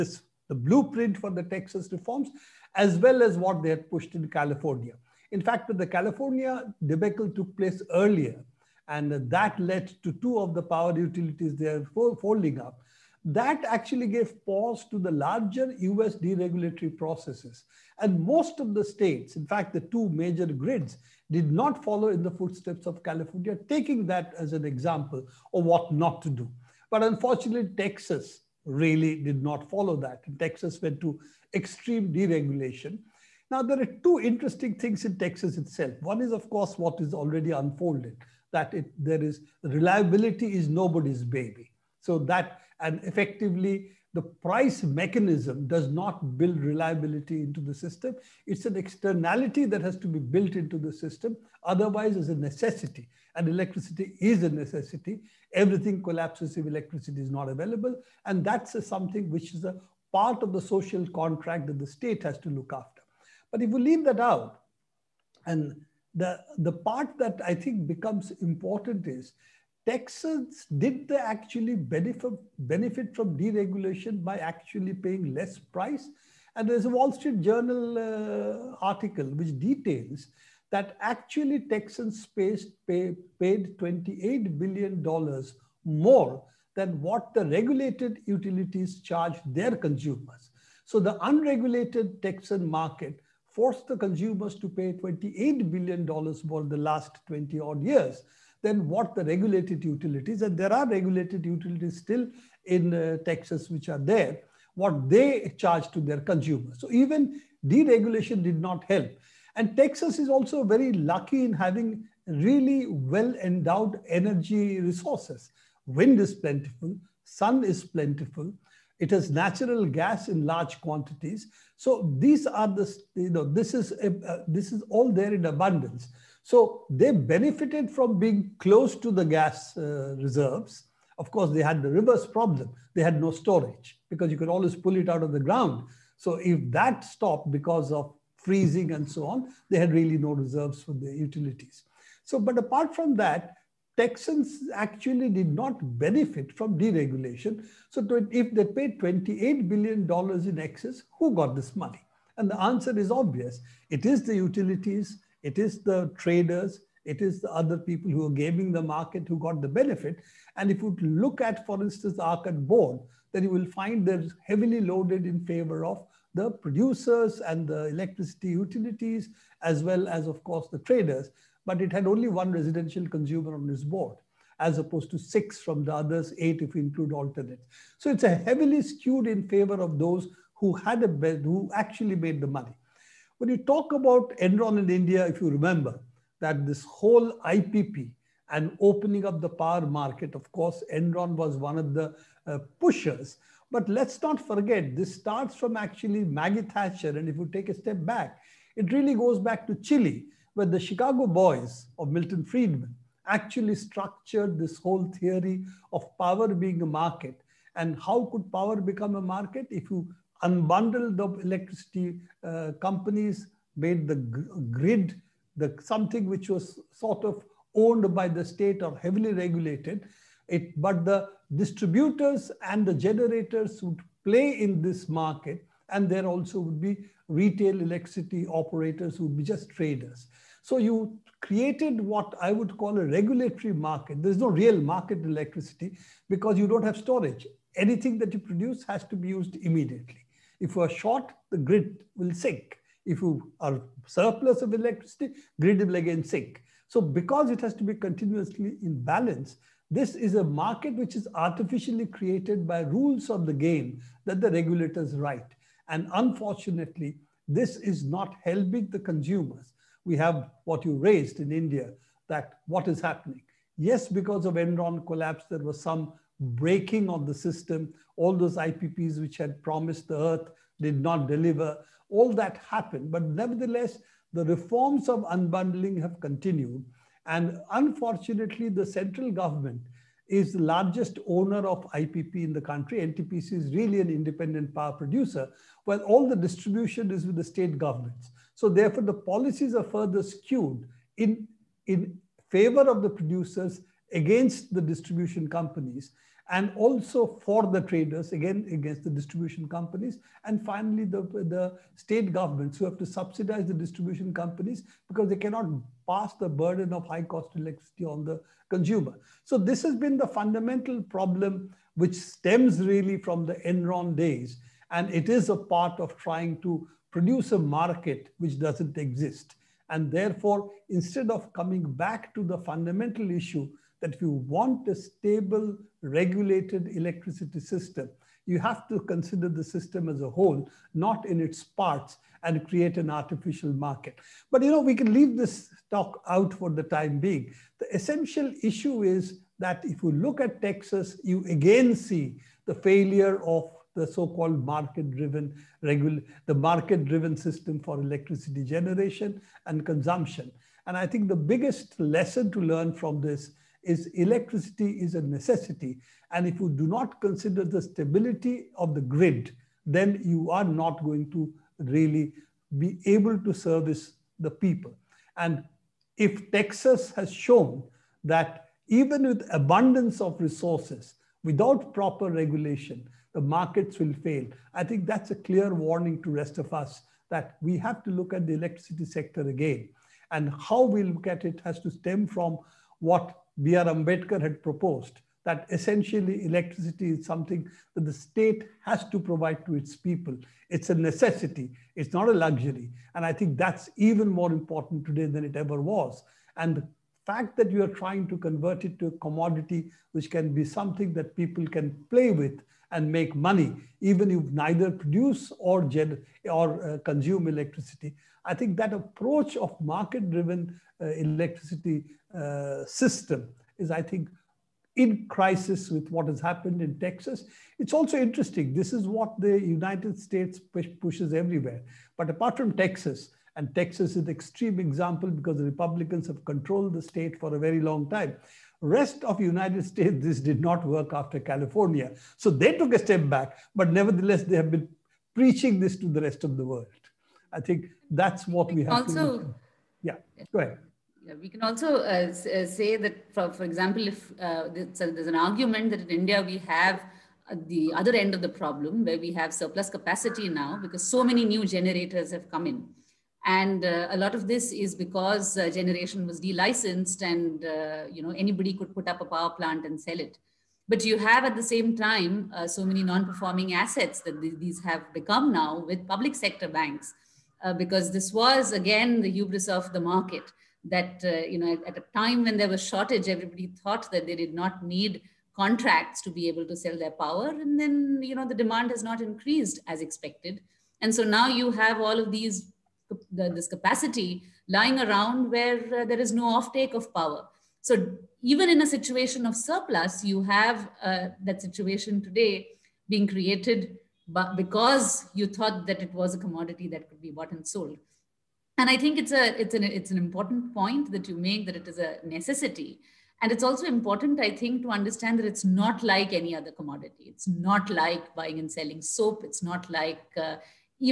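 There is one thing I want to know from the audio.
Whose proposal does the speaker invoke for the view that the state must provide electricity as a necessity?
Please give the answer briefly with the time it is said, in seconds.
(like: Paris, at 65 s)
B.R. Ambedkar, at 383 s.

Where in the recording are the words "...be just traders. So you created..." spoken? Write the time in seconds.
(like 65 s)
229 s.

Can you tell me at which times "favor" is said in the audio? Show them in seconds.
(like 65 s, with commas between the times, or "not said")
165 s, 179 s, 292 s.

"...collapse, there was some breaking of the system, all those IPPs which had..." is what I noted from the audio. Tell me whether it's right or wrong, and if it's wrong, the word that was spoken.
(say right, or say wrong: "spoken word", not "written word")
right.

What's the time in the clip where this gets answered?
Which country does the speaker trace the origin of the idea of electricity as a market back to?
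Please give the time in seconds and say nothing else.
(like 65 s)
199 s.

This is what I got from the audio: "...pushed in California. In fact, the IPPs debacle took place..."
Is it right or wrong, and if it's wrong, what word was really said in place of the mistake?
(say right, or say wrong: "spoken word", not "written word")
wrong: "California", not "IPPs".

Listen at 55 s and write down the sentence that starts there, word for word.
Everything collapses if electricity is not available.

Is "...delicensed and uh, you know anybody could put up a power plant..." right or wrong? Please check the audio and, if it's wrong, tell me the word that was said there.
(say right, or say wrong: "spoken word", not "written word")
right.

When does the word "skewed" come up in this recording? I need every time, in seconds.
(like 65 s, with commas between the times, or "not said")
178 s, 290 s.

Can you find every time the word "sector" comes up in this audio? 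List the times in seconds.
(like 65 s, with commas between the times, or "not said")
379 s, 466 s.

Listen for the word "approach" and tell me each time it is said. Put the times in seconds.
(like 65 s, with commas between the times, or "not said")
408 s.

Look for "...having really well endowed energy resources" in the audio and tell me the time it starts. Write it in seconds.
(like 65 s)
111 s.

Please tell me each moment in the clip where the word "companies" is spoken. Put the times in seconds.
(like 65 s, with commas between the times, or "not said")
212 s, 295 s, 299 s, 304 s.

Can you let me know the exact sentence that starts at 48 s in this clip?
It's an externality that has to be built into the system.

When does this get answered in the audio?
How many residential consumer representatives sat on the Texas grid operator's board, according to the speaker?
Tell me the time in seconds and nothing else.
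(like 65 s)
172 s.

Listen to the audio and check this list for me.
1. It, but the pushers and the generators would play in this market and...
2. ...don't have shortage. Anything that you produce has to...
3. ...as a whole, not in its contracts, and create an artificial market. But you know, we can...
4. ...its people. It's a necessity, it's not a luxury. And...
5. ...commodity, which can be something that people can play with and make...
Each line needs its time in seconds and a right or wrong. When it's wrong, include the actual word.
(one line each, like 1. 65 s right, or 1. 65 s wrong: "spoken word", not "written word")
1. 220 s wrong: "distributors", not "pushers"
2. 236 s wrong: "storage", not "shortage"
3. 330 s wrong: "parts", not "contracts"
4. 389 s right
5. 399 s right.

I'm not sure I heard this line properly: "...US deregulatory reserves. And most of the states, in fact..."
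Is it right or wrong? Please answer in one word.
wrong.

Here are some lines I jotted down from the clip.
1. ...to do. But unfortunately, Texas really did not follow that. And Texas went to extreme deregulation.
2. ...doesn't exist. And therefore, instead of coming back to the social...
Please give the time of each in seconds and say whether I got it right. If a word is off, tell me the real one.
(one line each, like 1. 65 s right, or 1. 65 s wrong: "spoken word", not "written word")
1. 26 s right
2. 318 s wrong: "fundamental", not "social".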